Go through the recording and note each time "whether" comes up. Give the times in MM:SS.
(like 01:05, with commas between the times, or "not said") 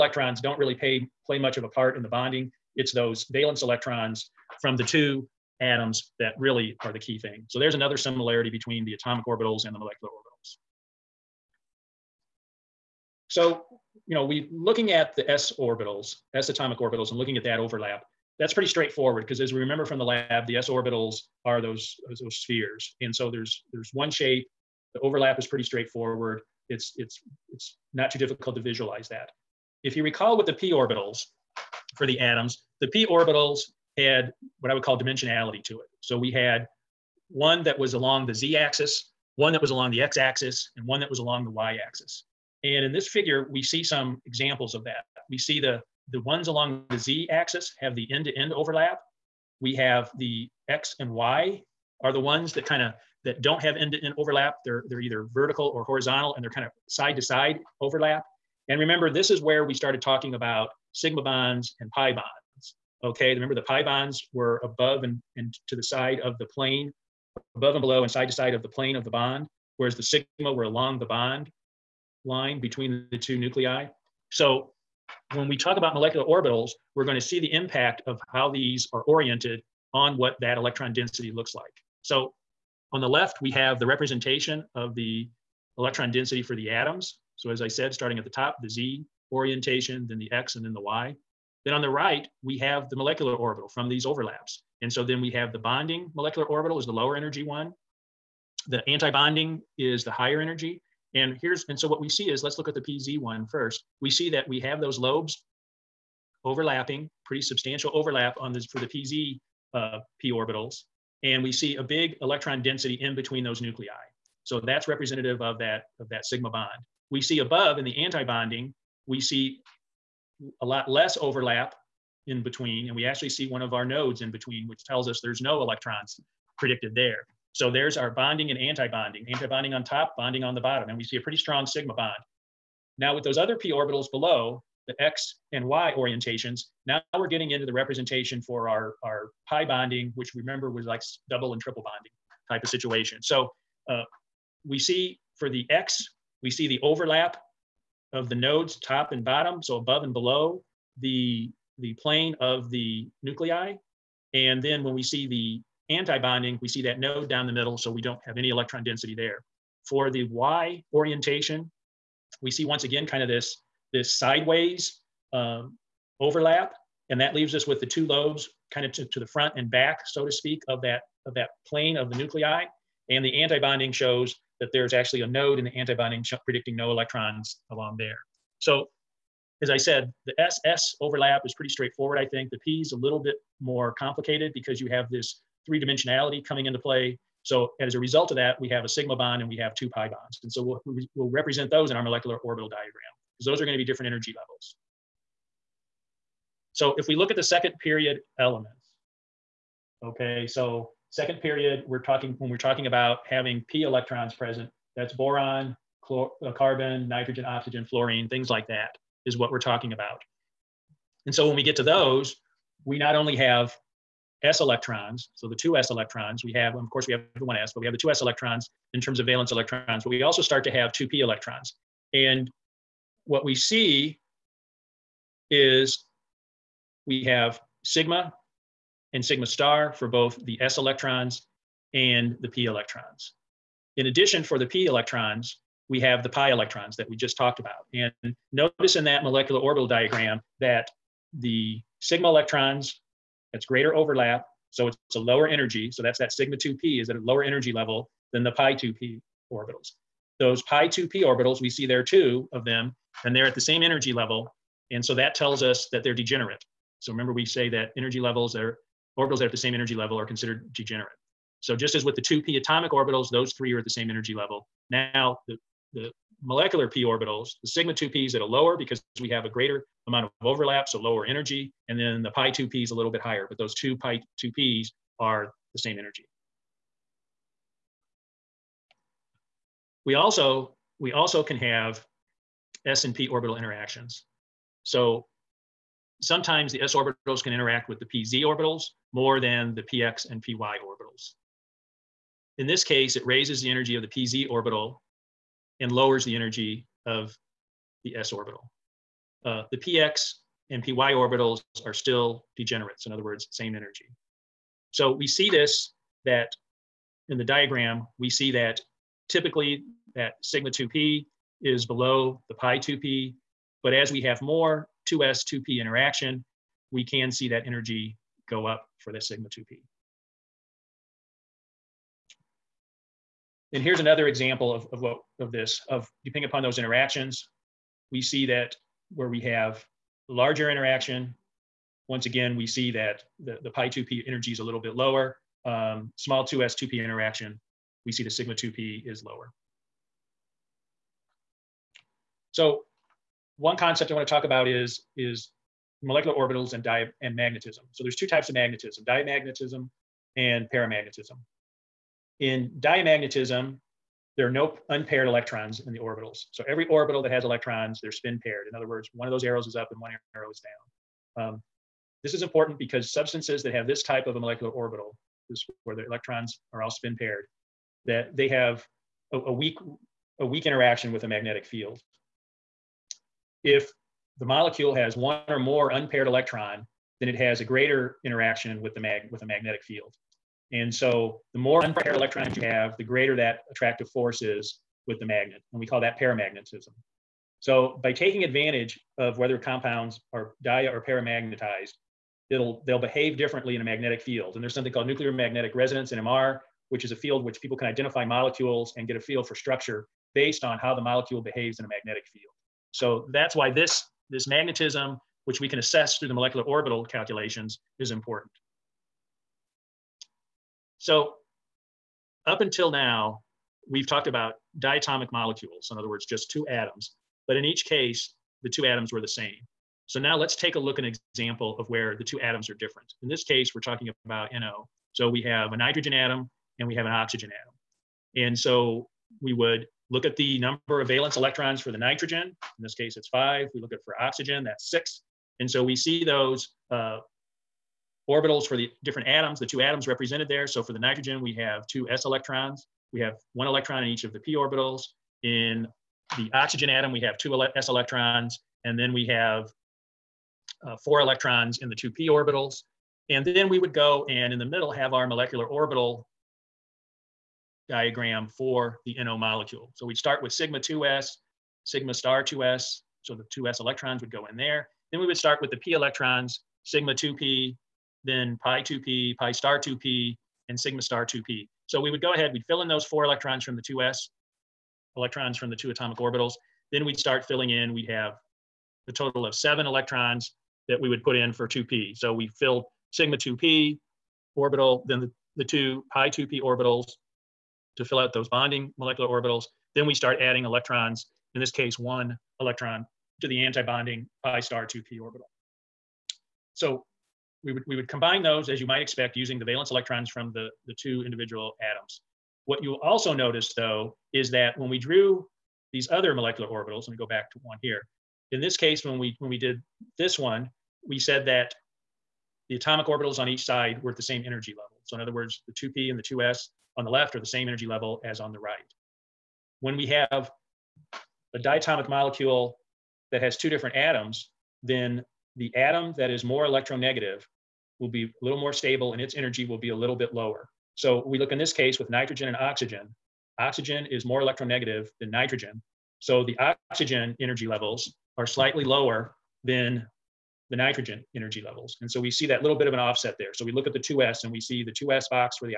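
06:29.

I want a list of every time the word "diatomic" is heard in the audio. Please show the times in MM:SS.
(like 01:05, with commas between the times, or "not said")
06:54, 08:41.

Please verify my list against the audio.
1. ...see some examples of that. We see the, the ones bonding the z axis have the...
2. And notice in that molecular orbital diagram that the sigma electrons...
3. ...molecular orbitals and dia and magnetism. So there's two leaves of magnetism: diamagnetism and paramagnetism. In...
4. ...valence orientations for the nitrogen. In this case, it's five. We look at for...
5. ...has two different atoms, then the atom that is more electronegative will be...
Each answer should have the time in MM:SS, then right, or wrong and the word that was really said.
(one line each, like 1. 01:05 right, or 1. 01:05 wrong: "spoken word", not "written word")
1. 00:43 wrong: "along", not "bonding"
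2. 03:57 right
3. 05:46 wrong: "types", not "leaves"
4. 07:11 wrong: "electrons", not "orientations"
5. 08:43 right.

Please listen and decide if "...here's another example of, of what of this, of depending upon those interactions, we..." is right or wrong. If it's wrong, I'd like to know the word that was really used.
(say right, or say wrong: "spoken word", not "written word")
right.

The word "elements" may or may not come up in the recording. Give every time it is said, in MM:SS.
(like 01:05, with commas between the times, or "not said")
03:18.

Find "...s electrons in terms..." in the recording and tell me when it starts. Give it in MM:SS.
03:38.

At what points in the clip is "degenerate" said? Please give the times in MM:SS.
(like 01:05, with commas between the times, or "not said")
04:16, 04:20, 05:02.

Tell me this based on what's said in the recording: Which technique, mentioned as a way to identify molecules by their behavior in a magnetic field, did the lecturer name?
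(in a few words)
Nuclear magnetic resonance.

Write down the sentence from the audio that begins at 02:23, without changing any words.
So uh, we see for the X, we see the overlap of the nodes top and bottom, so above and below.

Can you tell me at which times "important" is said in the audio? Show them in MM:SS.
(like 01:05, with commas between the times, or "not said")
06:02, 06:48.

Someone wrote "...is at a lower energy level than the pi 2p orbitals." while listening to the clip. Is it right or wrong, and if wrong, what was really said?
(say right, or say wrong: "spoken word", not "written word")
right.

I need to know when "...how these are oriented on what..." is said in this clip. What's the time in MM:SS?
01:18.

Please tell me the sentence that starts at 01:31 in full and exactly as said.
Then on the right, we have the molecular orbital from these overlaps.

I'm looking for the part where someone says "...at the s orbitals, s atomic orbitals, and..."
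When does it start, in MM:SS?
00:14.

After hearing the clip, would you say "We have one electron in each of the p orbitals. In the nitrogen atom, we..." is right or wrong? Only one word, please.
wrong.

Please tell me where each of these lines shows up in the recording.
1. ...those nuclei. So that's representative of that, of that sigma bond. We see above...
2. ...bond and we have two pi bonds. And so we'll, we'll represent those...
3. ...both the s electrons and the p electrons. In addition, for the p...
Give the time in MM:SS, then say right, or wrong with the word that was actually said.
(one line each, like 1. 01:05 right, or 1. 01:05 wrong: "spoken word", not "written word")
1. 01:53 right
2. 03:09 right
3. 03:50 right.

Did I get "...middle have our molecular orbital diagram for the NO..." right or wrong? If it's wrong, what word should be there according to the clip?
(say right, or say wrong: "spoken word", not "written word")
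right.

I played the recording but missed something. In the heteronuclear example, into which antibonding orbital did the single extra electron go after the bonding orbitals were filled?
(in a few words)
pi star 2p.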